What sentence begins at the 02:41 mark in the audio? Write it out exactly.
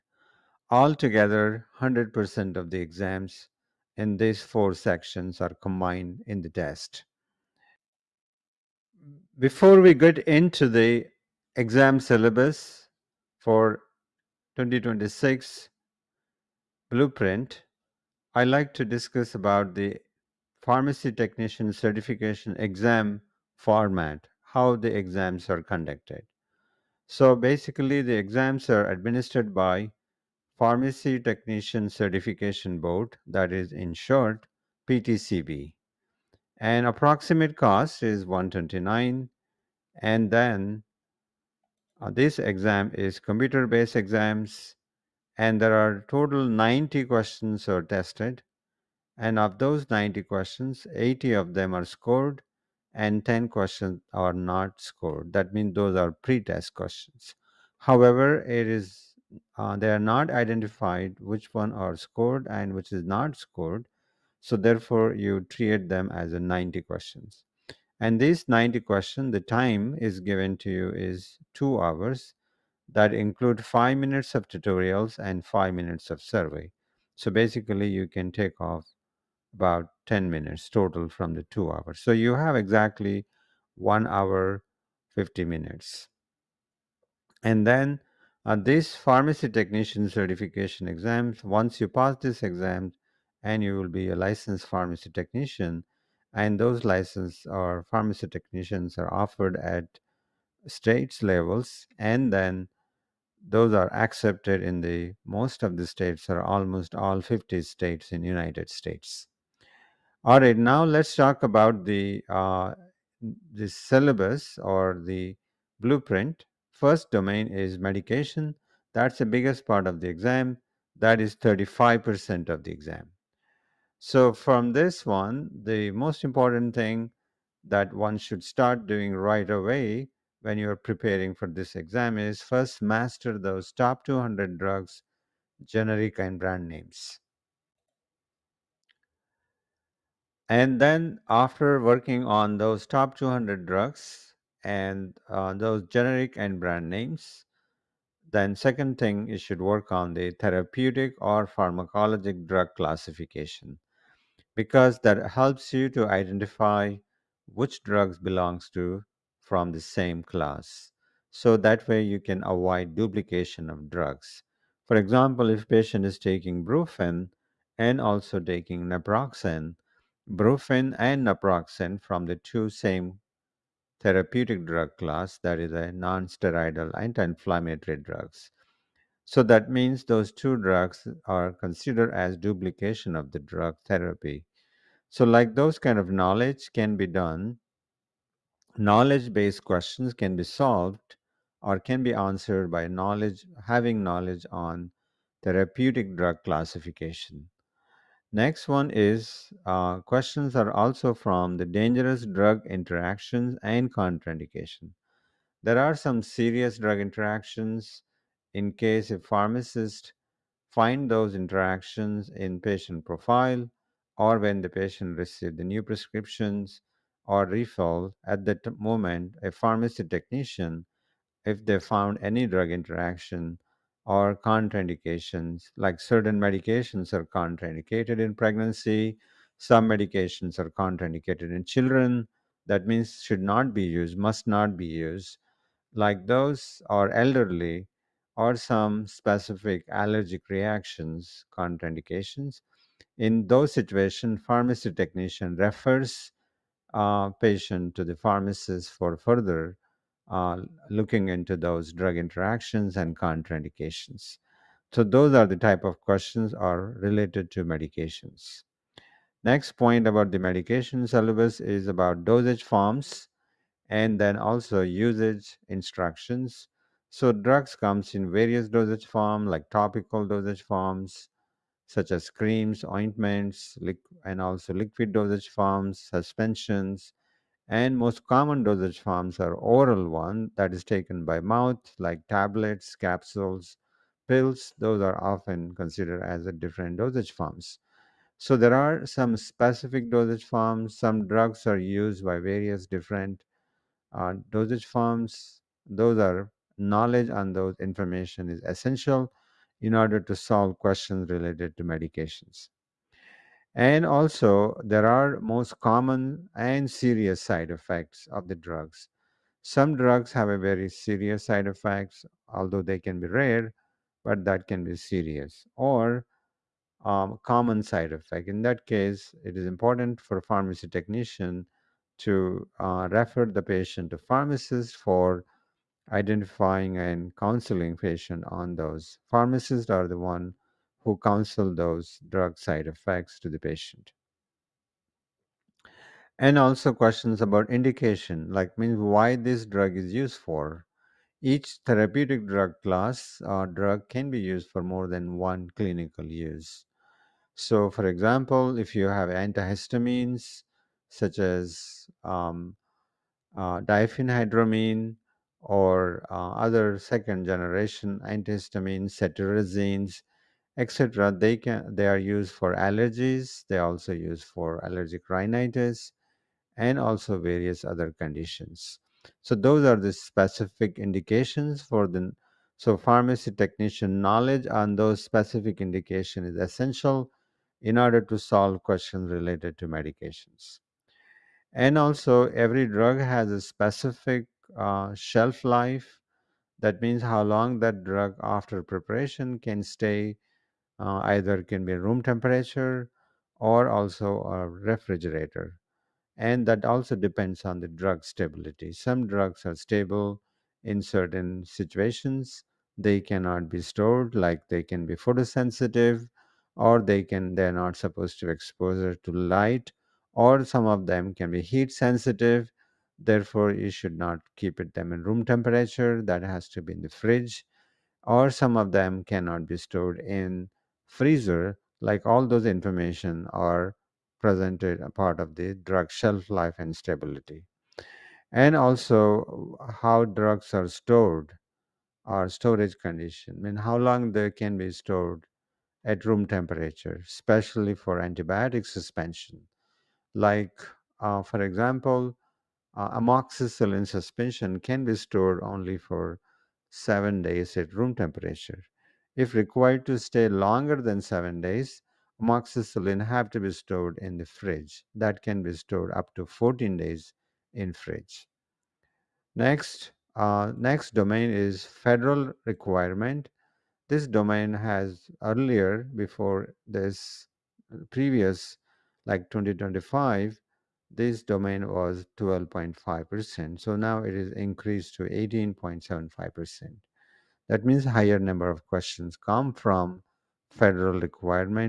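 So that way you can avoid duplication of drugs.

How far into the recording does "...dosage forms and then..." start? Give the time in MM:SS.
04:22.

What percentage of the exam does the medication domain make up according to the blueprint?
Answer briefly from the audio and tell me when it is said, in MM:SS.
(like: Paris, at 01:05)
35%, at 02:01.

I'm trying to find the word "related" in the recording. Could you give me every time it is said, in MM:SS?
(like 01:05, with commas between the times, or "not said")
04:17, 05:01, 06:19.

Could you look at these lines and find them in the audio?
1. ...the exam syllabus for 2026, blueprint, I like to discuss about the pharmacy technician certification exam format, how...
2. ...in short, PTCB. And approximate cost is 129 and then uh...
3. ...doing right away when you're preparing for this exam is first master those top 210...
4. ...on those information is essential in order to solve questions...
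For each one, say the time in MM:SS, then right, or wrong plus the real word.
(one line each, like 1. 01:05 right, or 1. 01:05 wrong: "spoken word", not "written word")
1. 00:10 right
2. 00:33 right
3. 02:08 wrong: "200", not "210"
4. 04:57 right.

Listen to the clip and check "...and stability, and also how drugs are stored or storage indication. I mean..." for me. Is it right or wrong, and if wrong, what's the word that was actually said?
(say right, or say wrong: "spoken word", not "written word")
wrong: "condition", not "indication".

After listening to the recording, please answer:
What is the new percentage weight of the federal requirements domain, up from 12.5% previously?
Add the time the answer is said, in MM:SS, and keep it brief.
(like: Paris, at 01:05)
18.75%, at 07:55.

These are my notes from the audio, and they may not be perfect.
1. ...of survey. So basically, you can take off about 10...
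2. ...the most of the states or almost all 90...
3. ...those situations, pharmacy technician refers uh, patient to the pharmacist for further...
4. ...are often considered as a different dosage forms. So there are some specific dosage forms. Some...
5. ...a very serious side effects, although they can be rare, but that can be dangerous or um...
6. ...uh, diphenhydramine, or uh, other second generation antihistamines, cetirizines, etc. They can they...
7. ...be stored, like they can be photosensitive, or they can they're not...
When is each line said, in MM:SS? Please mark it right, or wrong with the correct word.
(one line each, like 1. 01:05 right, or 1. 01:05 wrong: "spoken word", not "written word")
1. 01:16 right
2. 01:44 wrong: "50", not "90"
3. 04:03 right
4. 04:45 right
5. 05:10 wrong: "serious", not "dangerous"
6. 05:53 right
7. 06:43 right.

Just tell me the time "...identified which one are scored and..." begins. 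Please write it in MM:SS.
01:00.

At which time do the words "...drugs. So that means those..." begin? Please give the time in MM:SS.
02:57.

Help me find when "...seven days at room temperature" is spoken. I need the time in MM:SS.
07:26.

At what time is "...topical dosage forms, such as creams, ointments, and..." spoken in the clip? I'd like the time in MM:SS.
04:29.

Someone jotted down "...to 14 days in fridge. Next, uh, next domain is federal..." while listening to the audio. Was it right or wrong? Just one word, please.
right.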